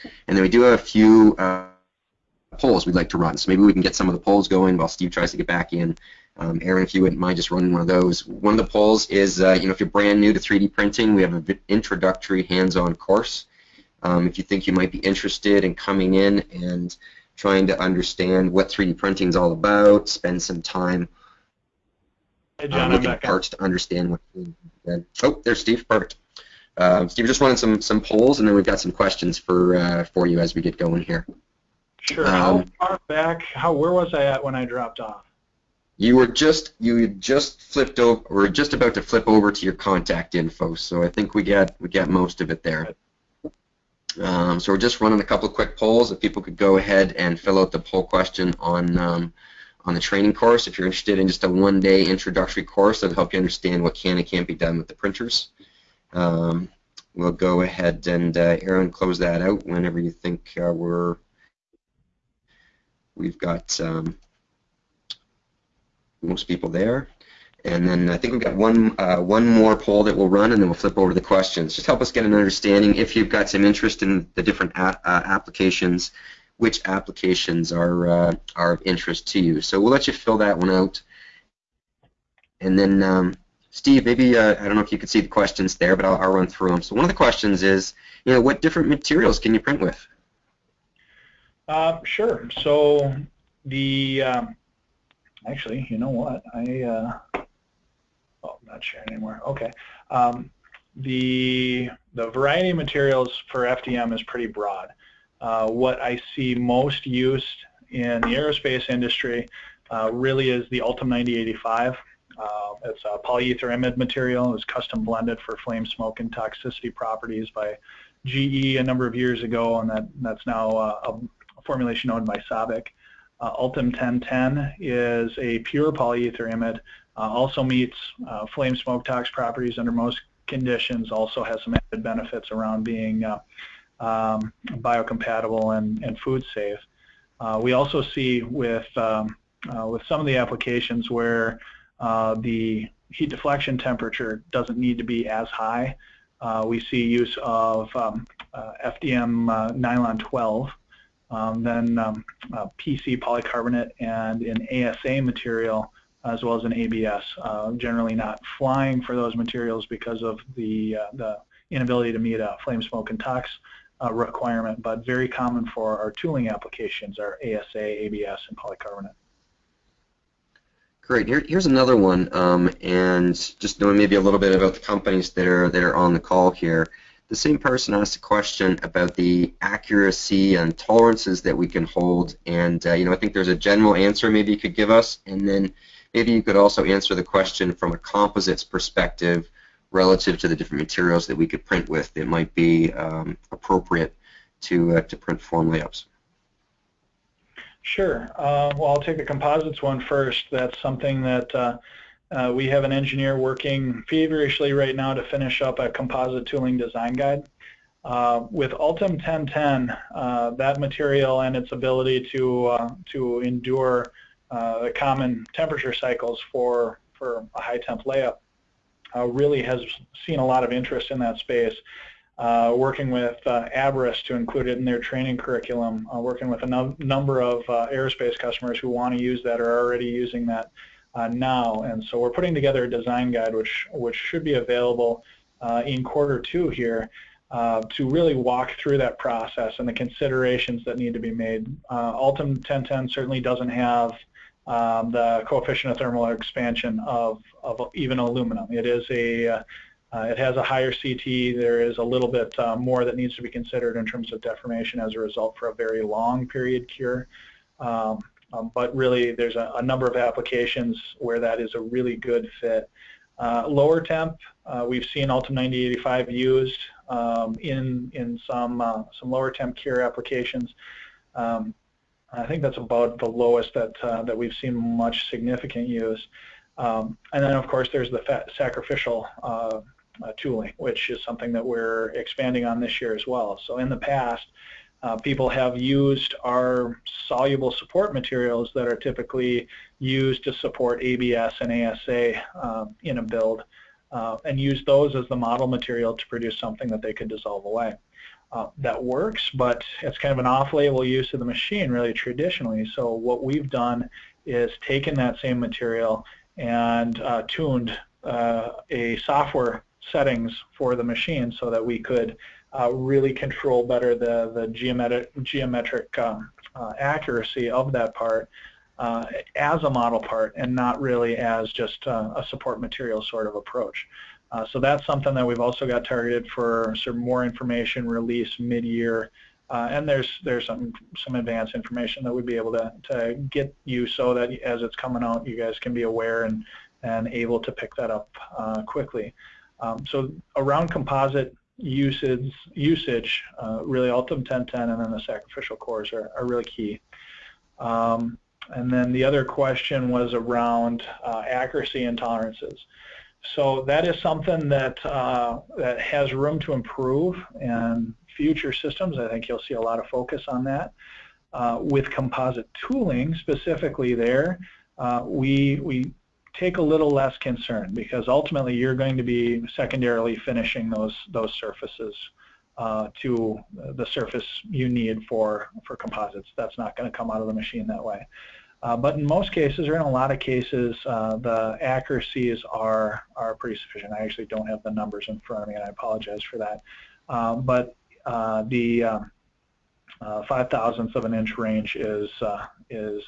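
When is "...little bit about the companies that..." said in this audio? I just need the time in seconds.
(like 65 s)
174 s.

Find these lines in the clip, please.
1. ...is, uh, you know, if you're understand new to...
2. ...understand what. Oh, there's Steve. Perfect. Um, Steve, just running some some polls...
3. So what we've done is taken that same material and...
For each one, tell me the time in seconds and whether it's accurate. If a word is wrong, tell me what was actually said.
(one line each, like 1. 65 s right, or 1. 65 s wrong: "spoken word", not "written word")
1. 9 s wrong: "brand", not "understand"
2. 23 s right
3. 302 s right.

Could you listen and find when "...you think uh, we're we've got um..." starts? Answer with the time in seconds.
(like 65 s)
59 s.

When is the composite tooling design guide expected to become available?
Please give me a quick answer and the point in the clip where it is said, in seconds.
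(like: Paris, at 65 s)
Quarter 2, at 236 s.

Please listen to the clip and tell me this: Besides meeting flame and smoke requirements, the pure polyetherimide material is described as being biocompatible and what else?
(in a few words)
Food safe.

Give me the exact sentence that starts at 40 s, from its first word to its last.
So I think we got we got most of it there.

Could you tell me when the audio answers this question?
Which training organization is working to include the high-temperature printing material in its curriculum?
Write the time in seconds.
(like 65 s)
223 s.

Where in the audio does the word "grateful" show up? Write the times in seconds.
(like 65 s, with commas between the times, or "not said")
not said.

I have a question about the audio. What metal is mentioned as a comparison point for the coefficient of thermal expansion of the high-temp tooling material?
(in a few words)
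Aluminum.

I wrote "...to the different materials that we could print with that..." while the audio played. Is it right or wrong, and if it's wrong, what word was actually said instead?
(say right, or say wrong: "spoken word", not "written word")
right.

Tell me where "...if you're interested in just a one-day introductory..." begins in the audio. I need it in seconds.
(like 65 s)
50 s.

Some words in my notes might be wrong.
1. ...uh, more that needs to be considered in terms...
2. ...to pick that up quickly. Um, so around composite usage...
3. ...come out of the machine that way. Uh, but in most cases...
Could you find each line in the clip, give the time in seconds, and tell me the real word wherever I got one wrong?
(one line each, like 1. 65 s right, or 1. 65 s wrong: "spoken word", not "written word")
1. 252 s right
2. 337 s right
3. 377 s right.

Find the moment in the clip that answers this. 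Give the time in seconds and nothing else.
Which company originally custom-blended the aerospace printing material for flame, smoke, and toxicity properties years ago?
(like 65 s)
118 s.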